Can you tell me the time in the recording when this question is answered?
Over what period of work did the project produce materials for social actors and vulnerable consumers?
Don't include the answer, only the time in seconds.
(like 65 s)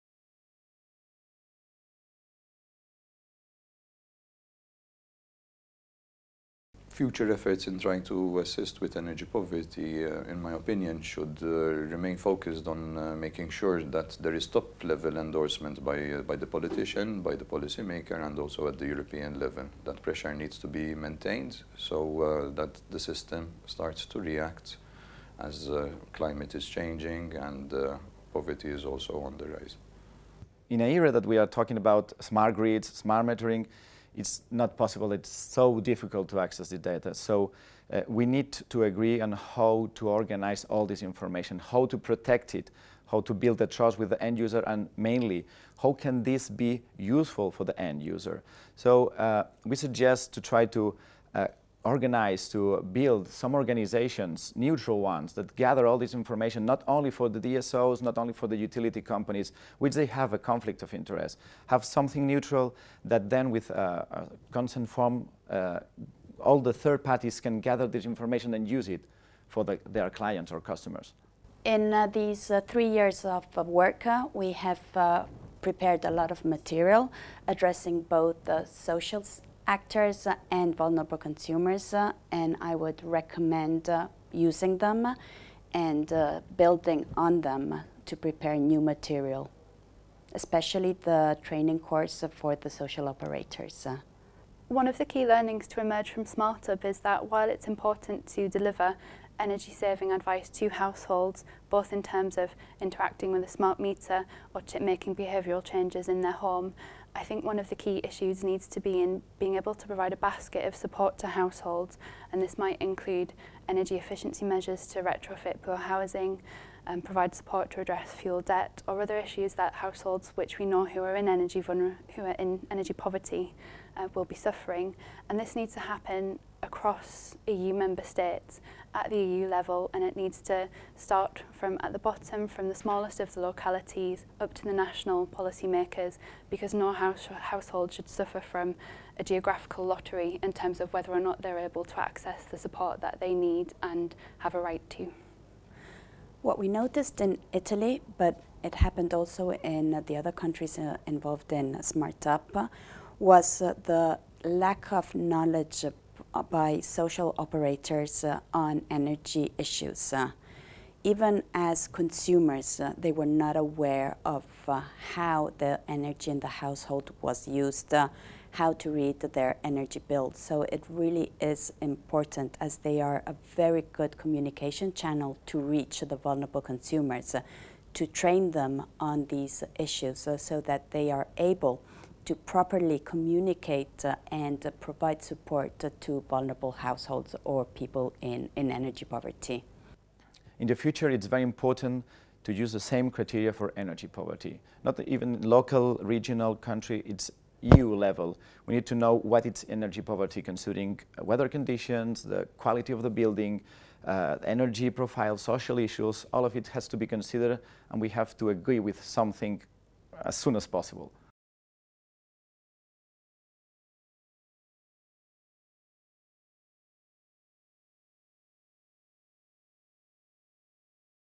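72 s.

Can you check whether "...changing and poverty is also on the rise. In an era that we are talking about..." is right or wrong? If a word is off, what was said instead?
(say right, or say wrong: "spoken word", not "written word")
right.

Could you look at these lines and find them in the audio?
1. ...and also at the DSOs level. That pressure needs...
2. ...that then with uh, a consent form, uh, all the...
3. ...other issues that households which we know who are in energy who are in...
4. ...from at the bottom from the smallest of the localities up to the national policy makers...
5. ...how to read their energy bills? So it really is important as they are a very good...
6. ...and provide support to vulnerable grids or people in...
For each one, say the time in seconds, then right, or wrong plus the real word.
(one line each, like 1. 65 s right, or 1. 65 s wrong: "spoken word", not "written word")
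1. 18 s wrong: "European", not "DSOs"
2. 63 s right
3. 119 s right
4. 131 s right
5. 168 s right
6. 184 s wrong: "households", not "grids".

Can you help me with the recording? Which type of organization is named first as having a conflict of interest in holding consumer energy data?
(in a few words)
DSOs.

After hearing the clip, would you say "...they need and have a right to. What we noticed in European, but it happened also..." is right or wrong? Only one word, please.
wrong.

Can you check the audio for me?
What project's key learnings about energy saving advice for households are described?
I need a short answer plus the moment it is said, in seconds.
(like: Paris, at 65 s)
SmartUp, at 96 s.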